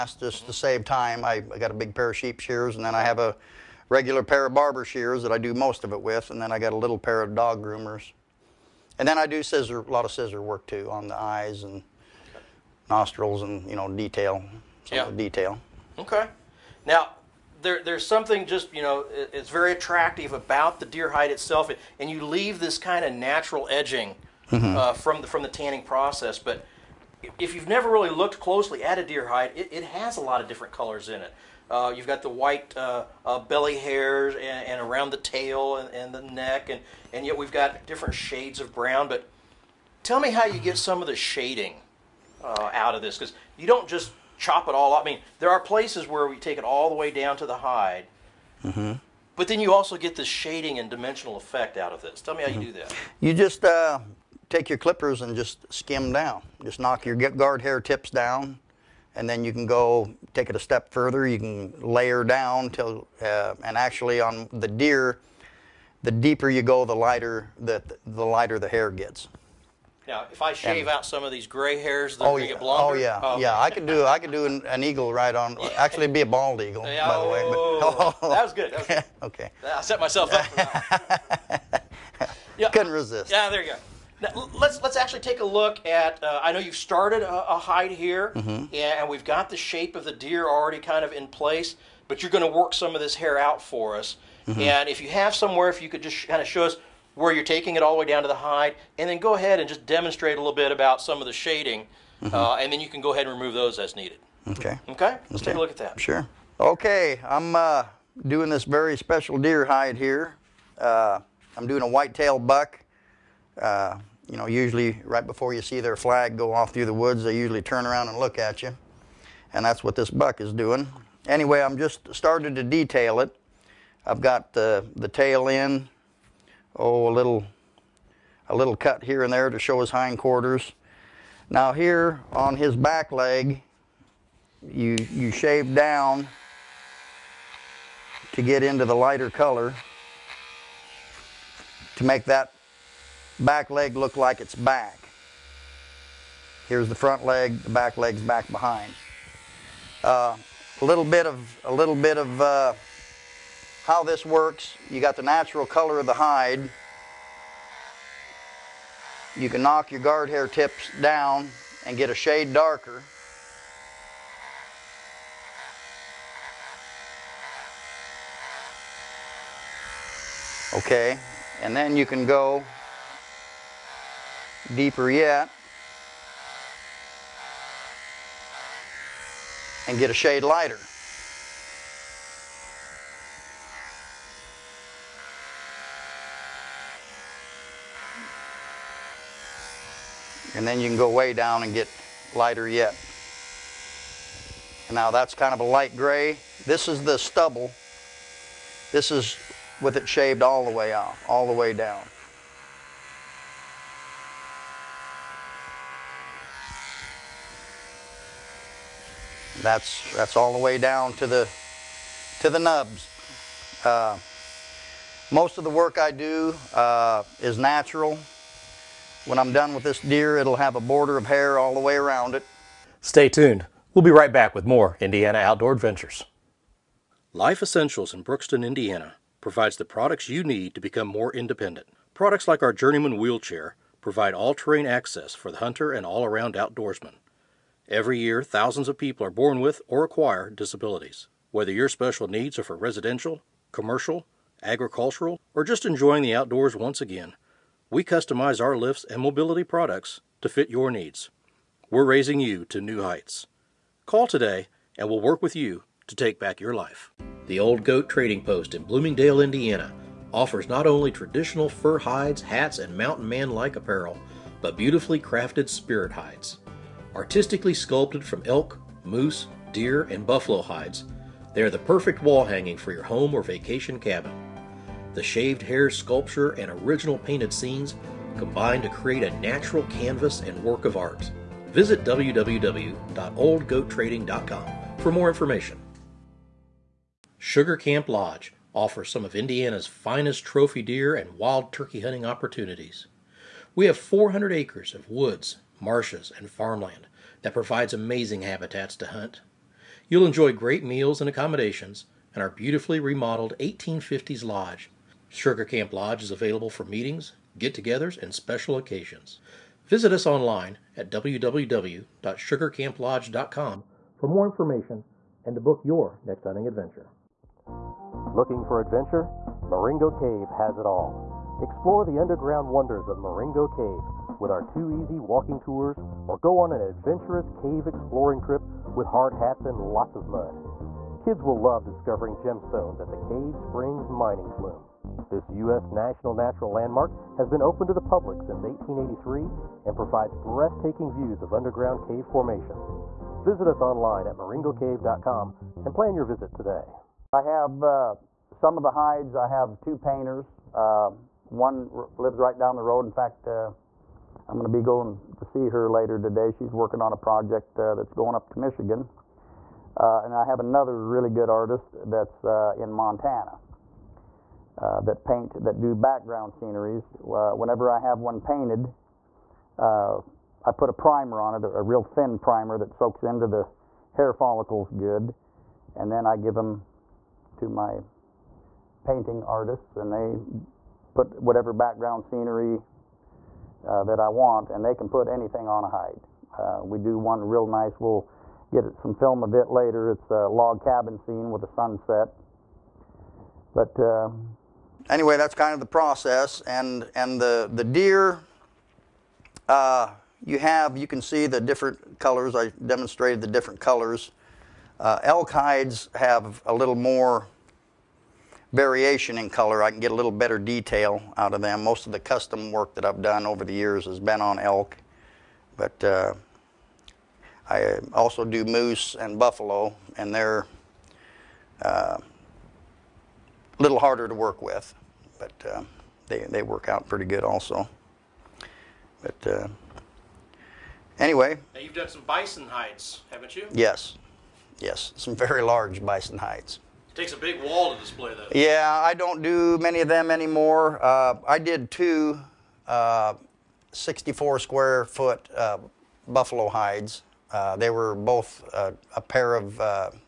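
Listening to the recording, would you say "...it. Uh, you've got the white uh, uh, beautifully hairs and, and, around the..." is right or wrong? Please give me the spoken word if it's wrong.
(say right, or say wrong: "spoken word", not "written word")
wrong: "belly", not "beautifully".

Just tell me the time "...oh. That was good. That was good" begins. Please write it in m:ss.
1:18.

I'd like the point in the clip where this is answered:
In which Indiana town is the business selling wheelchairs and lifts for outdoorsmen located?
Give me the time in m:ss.
3:48.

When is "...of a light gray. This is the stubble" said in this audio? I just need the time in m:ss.
3:15.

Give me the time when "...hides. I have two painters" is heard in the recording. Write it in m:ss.
5:48.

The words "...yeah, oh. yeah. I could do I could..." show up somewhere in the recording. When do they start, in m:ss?
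1:13.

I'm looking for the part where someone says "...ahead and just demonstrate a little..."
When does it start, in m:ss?
1:39.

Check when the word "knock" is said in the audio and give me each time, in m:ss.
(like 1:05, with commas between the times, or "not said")
0:56, 2:39.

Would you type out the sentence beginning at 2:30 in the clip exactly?
Uh, a little bit of, a little bit of uh, how this works.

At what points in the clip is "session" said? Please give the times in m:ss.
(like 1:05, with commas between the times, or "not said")
not said.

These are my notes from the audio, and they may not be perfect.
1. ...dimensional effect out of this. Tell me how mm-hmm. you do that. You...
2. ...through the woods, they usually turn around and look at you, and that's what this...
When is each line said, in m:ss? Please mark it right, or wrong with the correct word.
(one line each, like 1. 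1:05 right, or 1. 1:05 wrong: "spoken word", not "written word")
1. 0:50 right
2. 1:56 right.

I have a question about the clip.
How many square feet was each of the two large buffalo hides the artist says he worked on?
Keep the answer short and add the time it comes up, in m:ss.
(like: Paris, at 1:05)
64, at 7:23.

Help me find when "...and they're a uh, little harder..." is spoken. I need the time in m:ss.
7:00.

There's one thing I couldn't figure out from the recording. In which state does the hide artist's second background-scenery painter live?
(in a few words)
Montana.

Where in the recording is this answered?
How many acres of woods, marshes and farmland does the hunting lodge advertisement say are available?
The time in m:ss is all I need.
4:53.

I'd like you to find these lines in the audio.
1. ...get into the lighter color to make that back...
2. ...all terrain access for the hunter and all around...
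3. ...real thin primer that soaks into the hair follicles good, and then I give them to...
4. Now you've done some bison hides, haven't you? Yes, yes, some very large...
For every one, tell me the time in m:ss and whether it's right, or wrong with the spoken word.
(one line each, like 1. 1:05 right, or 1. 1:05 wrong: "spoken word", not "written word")
1. 2:18 right
2. 3:54 right
3. 6:11 right
4. 7:11 right.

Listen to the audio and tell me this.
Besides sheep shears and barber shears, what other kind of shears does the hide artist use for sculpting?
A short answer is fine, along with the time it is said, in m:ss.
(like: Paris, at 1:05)
dog groomers, at 0:07.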